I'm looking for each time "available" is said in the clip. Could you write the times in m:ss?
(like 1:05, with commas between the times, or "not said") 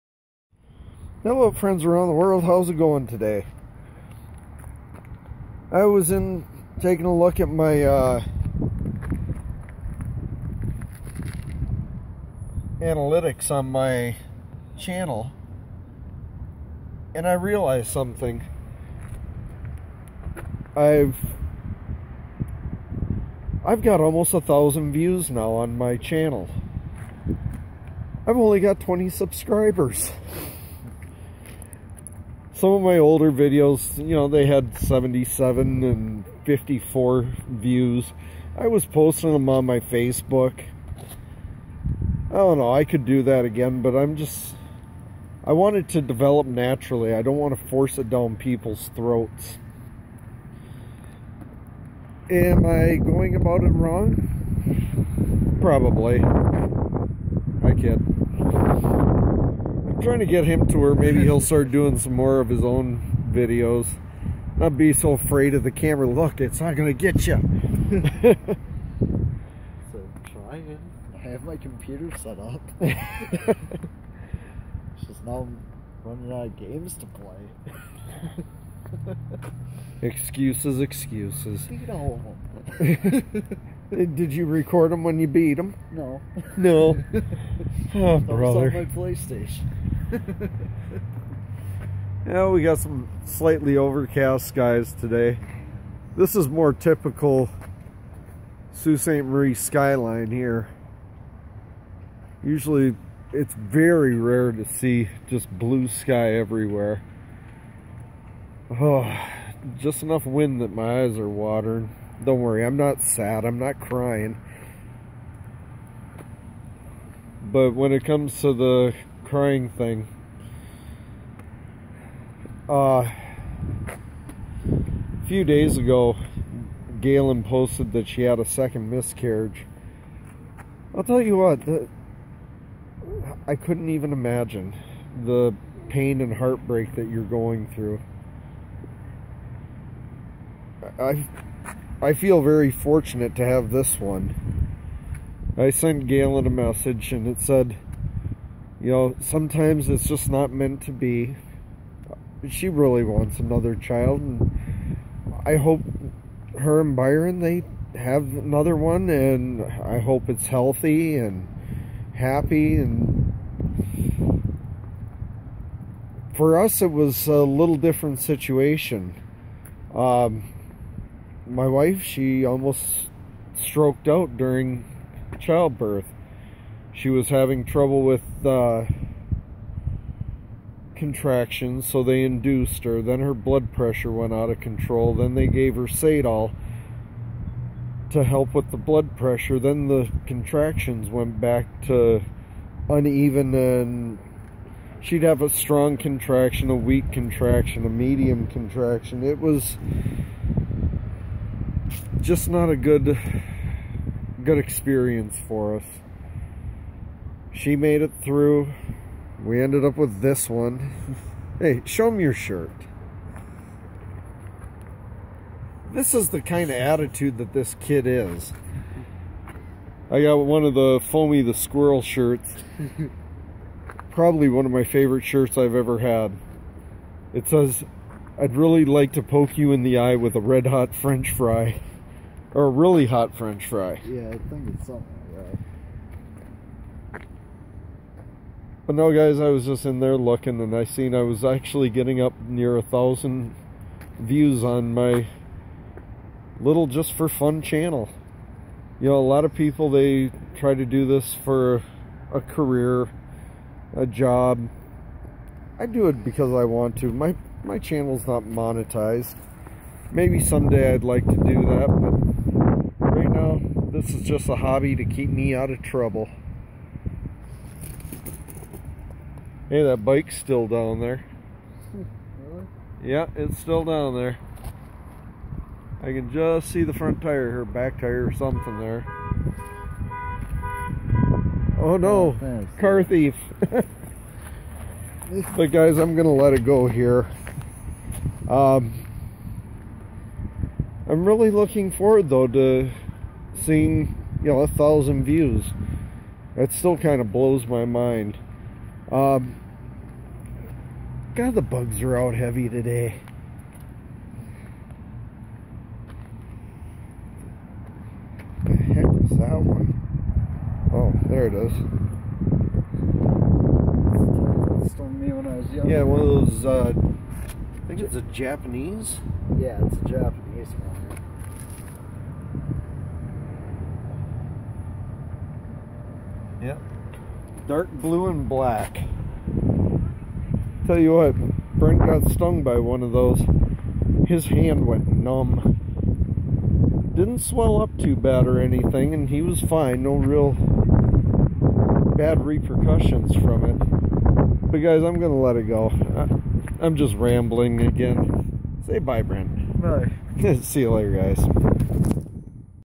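not said.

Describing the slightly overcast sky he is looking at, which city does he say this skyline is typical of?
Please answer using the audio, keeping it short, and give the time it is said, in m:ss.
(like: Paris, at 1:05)
Sault Ste. Marie, at 1:38.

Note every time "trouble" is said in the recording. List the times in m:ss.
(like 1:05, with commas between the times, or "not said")
2:57, 4:25.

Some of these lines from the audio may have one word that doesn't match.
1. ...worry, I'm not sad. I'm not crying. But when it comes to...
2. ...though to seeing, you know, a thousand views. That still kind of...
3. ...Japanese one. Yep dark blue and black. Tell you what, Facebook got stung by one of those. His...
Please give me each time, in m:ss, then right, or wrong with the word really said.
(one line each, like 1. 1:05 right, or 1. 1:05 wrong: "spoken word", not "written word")
1. 1:52 right
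2. 4:52 right
3. 5:20 wrong: "Brent", not "Facebook".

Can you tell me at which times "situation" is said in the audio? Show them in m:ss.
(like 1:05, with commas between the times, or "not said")
2:48.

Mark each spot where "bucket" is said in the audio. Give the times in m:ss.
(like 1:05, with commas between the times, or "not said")
not said.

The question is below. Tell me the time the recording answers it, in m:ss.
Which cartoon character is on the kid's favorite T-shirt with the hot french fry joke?
3:41.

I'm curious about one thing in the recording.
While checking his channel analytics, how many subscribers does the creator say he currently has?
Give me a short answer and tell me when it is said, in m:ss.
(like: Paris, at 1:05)
20, at 0:28.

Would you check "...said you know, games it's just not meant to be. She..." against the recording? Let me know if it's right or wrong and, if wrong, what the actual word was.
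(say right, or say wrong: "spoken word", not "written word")
wrong: "sometimes", not "games".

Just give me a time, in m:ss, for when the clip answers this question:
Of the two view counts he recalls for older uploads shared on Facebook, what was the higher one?
0:34.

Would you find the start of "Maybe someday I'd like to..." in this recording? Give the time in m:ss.
4:20.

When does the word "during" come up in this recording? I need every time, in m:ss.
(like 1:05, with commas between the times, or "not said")
2:54.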